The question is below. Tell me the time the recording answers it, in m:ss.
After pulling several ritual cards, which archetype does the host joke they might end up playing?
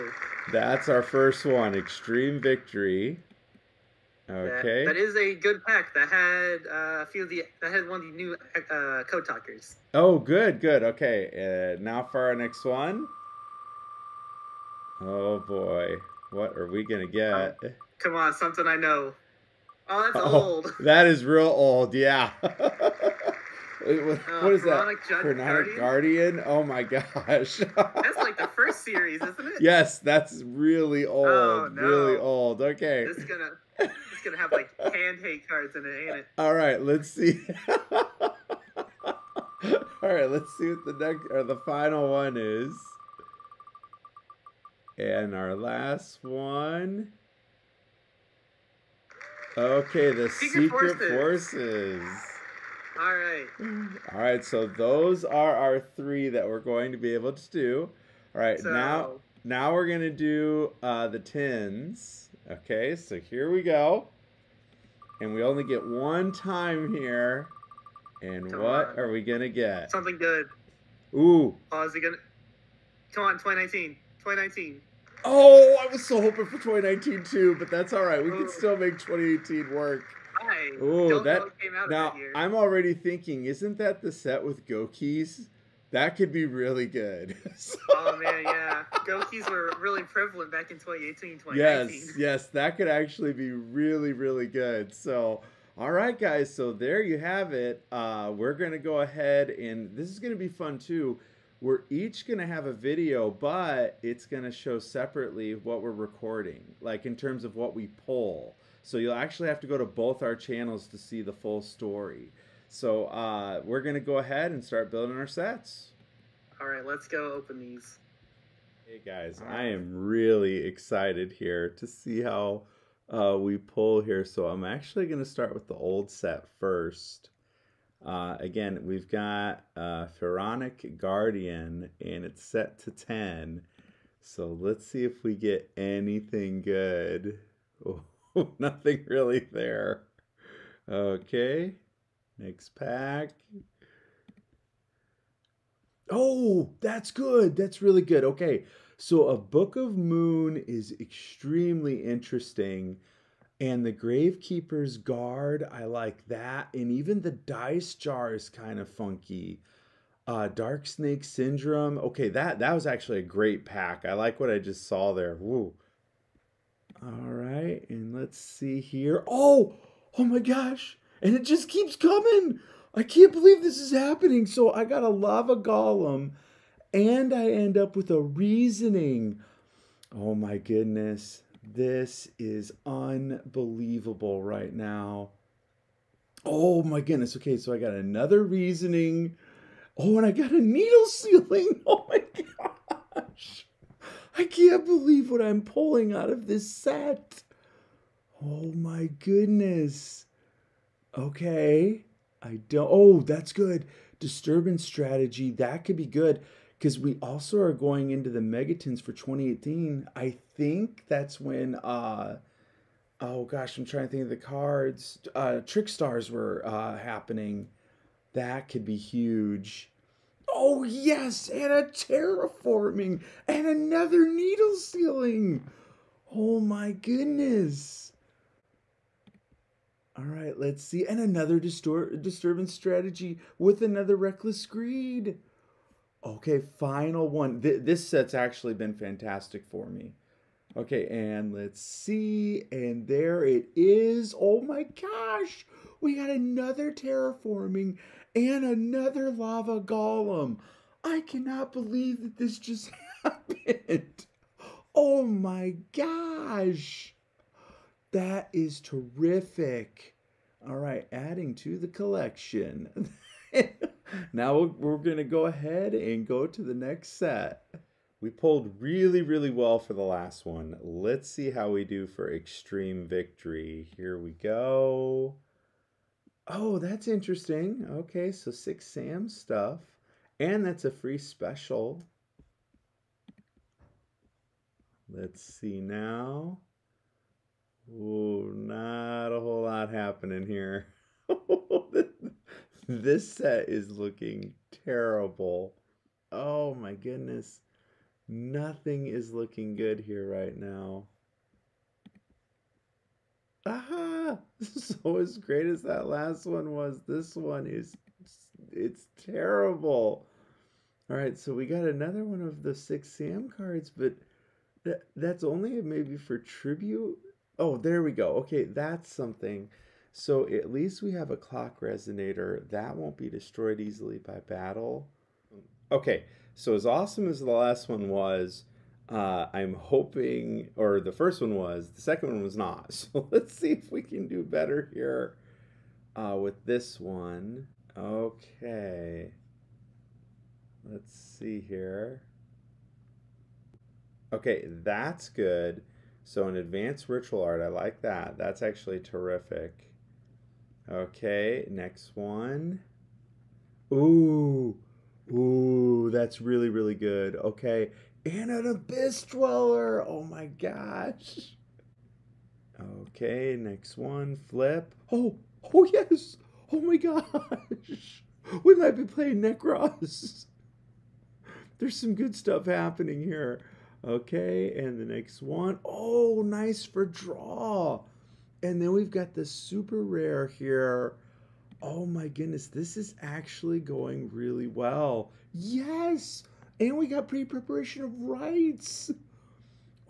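6:09.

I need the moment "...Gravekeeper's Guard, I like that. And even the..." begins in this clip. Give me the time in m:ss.
2:33.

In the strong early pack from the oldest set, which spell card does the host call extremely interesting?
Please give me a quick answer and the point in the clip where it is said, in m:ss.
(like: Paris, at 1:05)
Book of Moon, at 2:29.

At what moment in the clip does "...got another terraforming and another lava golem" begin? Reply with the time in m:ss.
4:06.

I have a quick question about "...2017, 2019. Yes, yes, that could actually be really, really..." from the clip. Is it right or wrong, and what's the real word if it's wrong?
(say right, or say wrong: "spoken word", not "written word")
wrong: "2018", not "2017".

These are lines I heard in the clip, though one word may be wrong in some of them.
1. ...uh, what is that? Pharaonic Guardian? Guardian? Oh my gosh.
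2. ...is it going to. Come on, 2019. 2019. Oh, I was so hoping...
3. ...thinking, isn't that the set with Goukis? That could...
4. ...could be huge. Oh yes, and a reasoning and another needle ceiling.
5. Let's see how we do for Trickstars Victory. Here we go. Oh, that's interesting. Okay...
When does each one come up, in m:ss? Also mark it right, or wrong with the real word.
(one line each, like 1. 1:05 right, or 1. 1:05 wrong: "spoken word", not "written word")
1. 0:22 right
2. 1:11 right
3. 1:22 right
4. 3:38 wrong: "terraforming", not "reasoning"
5. 4:30 wrong: "Extreme", not "Trickstars".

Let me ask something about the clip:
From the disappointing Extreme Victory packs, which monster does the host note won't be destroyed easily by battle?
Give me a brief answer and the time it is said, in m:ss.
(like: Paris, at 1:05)
Clock Resonator, at 5:21.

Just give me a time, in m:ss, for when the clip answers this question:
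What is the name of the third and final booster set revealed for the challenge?
0:50.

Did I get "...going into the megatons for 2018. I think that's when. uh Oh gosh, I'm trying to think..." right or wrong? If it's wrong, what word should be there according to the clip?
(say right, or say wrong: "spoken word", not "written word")
right.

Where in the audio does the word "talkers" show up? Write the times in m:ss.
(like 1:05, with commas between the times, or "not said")
0:09.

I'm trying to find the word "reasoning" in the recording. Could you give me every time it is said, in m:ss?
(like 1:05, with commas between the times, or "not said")
2:58, 3:08.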